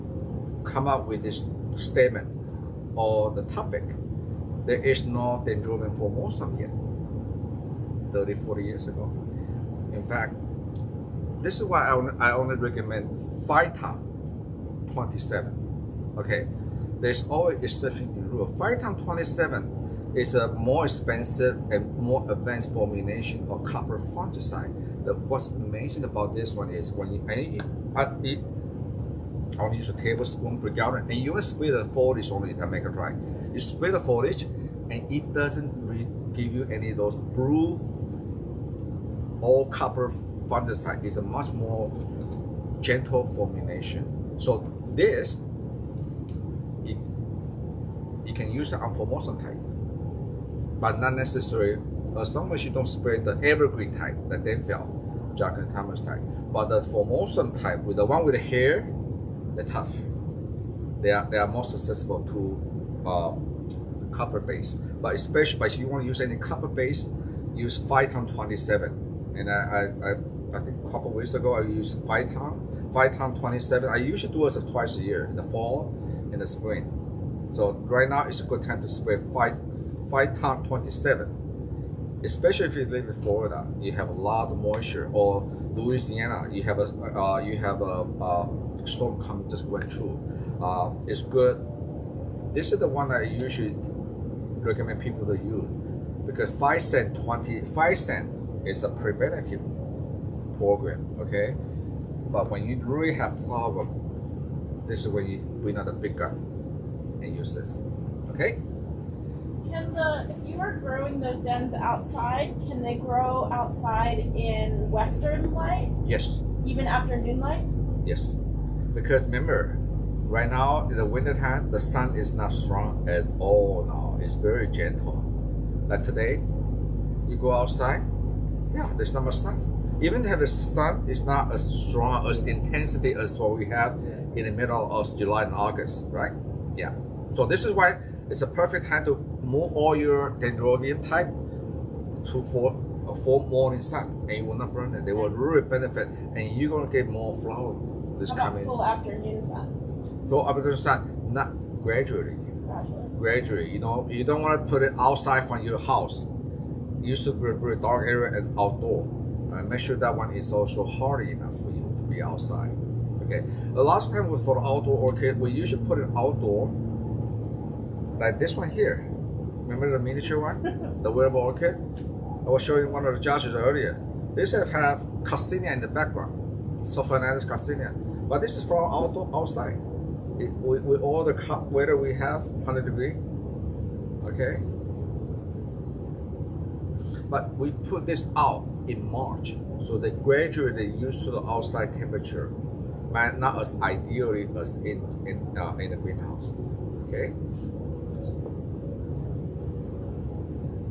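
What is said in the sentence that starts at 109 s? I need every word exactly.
Can the, if you are growing those dens outside, can they grow outside in western light?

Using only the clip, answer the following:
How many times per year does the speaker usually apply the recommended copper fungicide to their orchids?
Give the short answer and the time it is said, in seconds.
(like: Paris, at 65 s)
Twice, at 74 s.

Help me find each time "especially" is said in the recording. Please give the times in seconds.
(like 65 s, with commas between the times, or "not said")
65 s, 82 s.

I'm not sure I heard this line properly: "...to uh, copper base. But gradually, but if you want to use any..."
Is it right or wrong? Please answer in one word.
wrong.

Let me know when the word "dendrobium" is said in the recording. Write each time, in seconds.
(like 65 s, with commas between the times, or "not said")
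5 s, 140 s.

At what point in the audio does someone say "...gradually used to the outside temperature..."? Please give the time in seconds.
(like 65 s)
190 s.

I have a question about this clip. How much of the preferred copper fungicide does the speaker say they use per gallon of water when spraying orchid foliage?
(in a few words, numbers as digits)
1 tablespoon.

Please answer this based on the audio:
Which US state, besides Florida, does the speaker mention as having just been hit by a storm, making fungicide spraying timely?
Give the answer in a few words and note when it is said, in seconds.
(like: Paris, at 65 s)
Louisiana, at 85 s.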